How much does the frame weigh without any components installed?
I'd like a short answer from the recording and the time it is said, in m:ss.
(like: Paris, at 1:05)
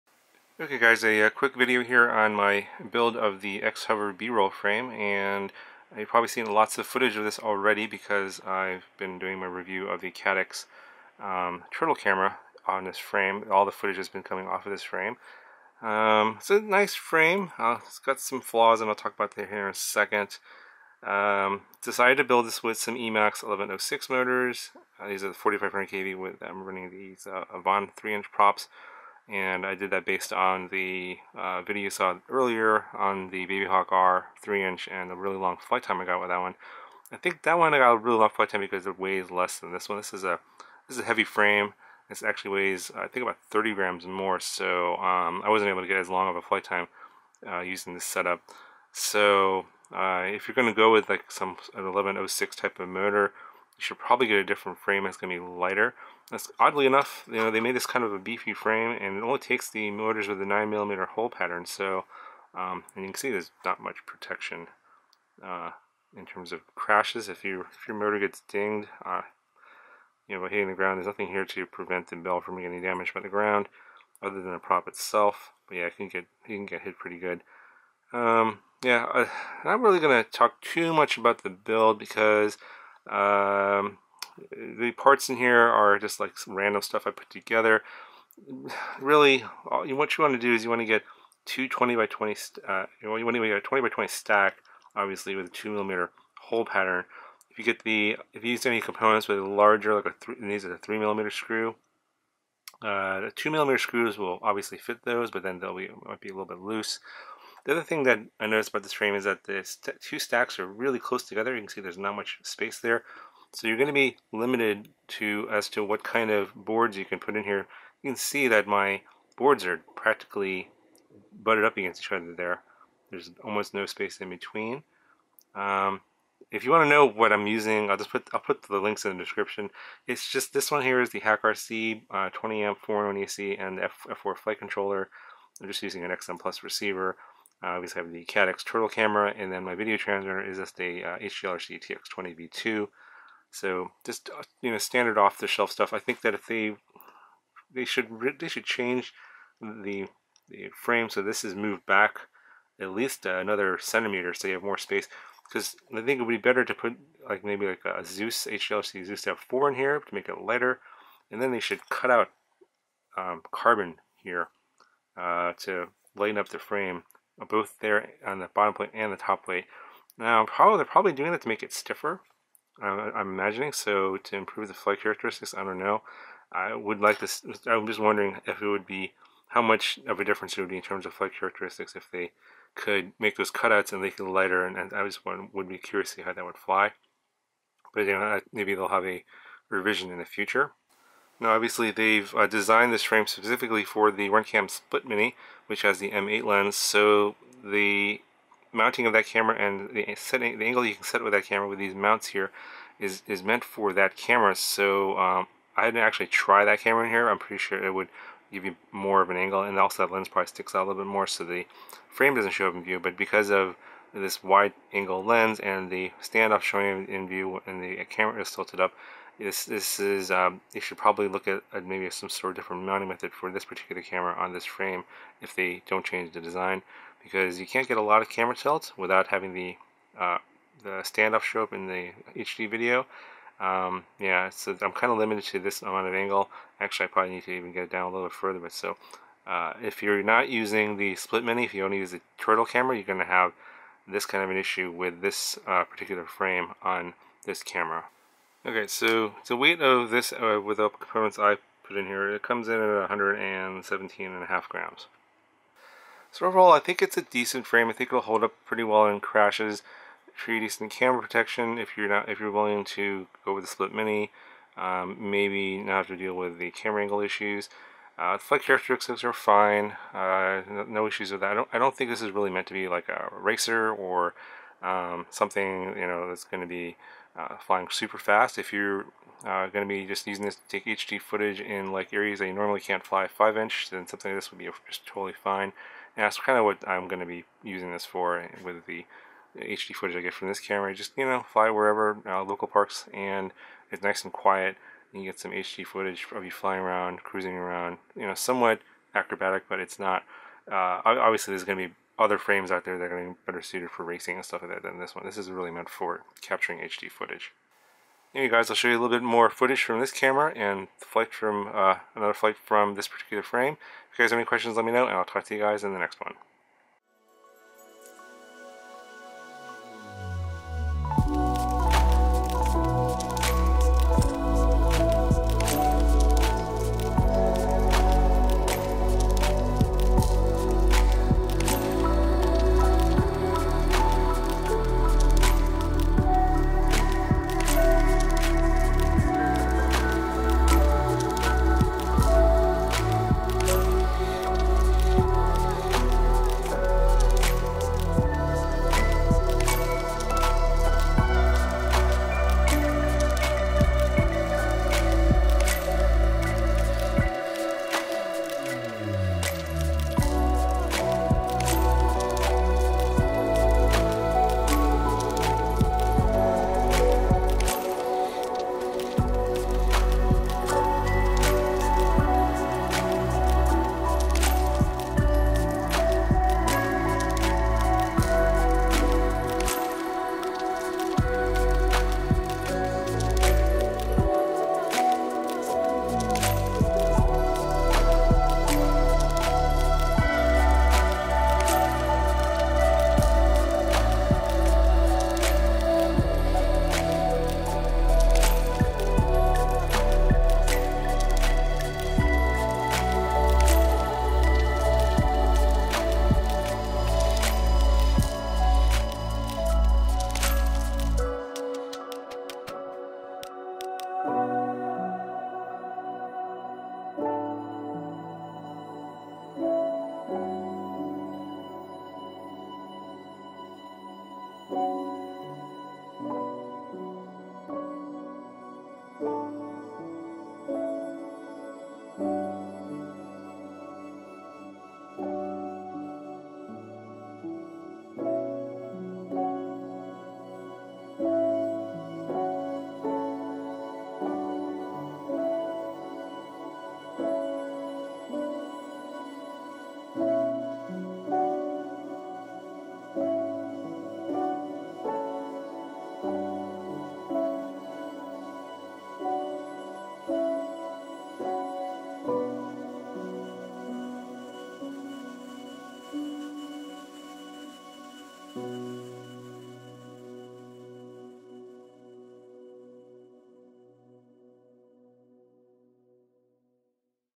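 117.5 grams, at 4:13.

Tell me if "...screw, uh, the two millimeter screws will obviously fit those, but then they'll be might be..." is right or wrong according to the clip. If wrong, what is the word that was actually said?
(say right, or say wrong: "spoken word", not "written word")
right.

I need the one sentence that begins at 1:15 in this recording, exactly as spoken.
But yeah, it can get, you can get hit pretty good.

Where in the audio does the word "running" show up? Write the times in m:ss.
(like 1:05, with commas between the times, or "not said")
0:26.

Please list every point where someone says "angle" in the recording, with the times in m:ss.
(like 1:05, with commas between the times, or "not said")
3:20, 3:29, 3:34, 3:56, 4:27.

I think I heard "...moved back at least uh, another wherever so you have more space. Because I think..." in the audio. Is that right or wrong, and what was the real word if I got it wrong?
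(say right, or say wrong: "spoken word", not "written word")
wrong: "centimeter", not "wherever".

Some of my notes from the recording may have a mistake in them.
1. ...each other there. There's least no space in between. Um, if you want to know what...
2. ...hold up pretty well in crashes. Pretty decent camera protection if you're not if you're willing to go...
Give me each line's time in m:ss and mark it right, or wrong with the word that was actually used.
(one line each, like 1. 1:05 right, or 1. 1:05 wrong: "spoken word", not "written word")
1. 2:02 wrong: "almost", not "least"
2. 4:18 right.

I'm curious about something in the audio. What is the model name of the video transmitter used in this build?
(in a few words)
HGLRC TX20V2.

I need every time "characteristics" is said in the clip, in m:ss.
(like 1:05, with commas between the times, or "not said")
2:55, 3:01, 4:28.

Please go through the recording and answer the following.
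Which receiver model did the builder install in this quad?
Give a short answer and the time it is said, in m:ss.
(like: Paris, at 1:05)
XM Plus, at 2:16.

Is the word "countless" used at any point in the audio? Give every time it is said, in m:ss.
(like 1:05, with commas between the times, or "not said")
not said.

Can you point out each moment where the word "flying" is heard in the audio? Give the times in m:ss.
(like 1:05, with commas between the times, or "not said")
4:37, 4:56.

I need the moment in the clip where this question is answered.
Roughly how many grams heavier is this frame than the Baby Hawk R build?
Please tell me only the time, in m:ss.
0:43.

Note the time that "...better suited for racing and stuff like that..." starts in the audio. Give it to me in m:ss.
5:03.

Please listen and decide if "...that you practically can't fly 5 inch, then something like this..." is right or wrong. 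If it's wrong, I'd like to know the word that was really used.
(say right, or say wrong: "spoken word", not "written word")
wrong: "normally", not "practically".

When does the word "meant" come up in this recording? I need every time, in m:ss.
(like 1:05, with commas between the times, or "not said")
3:23, 4:32, 5:05.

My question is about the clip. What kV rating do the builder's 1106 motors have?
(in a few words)
4500 kV.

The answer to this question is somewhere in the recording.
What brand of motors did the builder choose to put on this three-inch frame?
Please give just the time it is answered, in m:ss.
0:22.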